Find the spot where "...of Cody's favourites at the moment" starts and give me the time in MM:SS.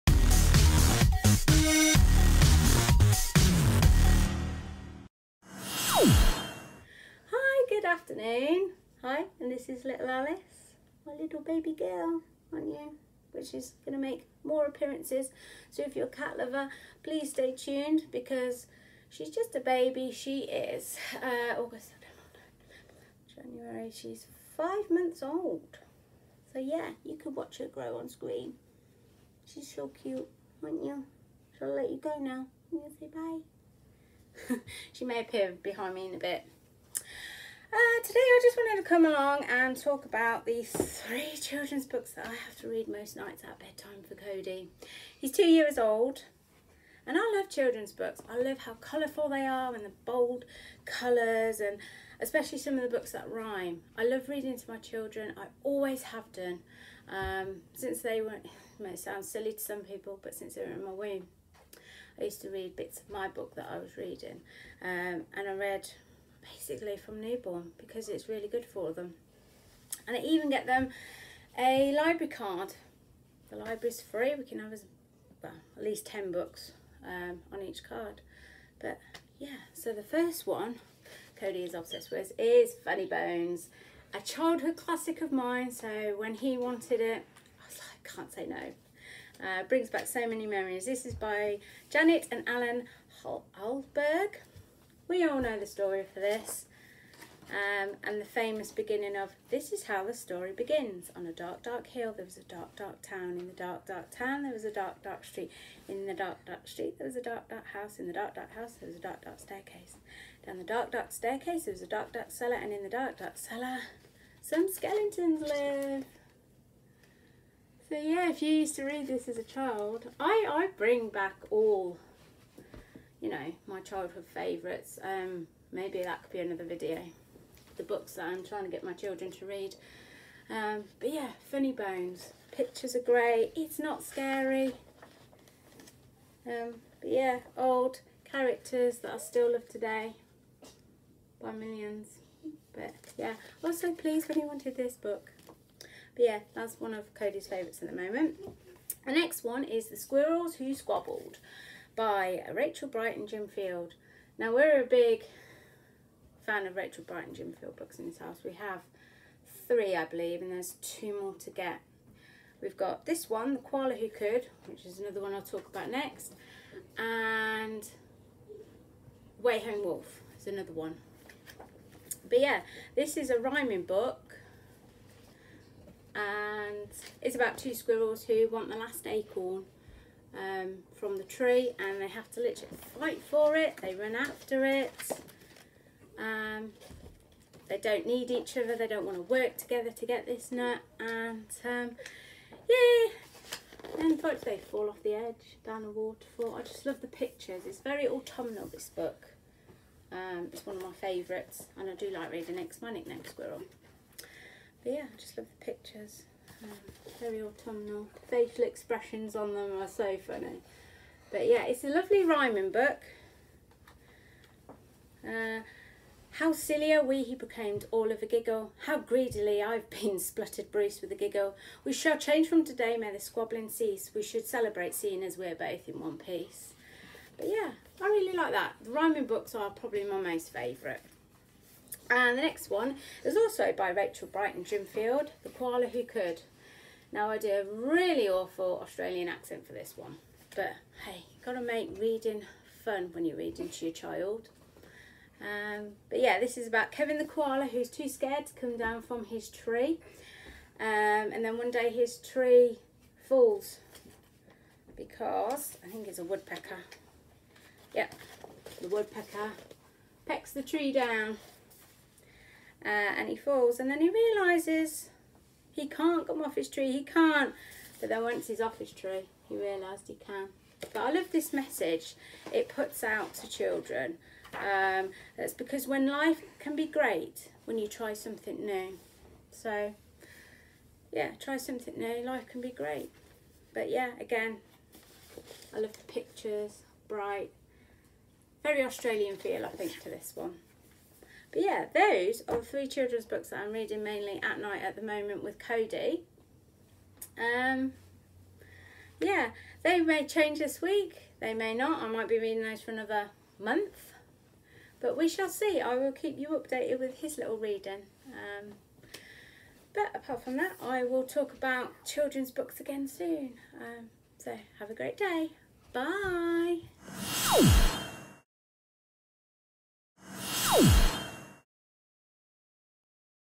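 02:26.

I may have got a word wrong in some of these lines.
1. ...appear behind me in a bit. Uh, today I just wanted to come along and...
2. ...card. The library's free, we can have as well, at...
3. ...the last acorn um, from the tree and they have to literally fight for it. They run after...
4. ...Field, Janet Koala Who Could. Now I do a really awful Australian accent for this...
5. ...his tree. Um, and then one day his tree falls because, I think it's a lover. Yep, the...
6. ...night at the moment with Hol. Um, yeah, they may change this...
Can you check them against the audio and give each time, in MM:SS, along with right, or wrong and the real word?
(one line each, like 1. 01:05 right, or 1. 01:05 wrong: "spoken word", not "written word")
1. 00:35 right
2. 01:12 right
3. 02:58 right
4. 03:54 wrong: "The", not "Janet"
5. 04:09 wrong: "woodpecker", not "lover"
6. 04:54 wrong: "Cody", not "Hol".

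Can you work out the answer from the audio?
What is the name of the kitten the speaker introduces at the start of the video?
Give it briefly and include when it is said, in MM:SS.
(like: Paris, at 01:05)
Alice, at 00:10.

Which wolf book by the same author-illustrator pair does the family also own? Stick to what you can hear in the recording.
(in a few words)
Way Home Wolf.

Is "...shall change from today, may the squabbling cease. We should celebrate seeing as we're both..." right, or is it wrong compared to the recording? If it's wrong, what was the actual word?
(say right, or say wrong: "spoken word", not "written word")
right.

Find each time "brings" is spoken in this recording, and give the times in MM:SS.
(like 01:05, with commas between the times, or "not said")
01:29, 02:00.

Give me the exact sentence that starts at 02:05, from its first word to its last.
Um, maybe that could be another video.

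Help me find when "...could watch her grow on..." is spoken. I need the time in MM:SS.
00:27.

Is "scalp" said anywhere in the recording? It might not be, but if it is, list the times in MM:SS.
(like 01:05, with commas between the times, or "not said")
not said.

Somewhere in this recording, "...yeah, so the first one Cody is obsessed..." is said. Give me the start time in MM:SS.
01:19.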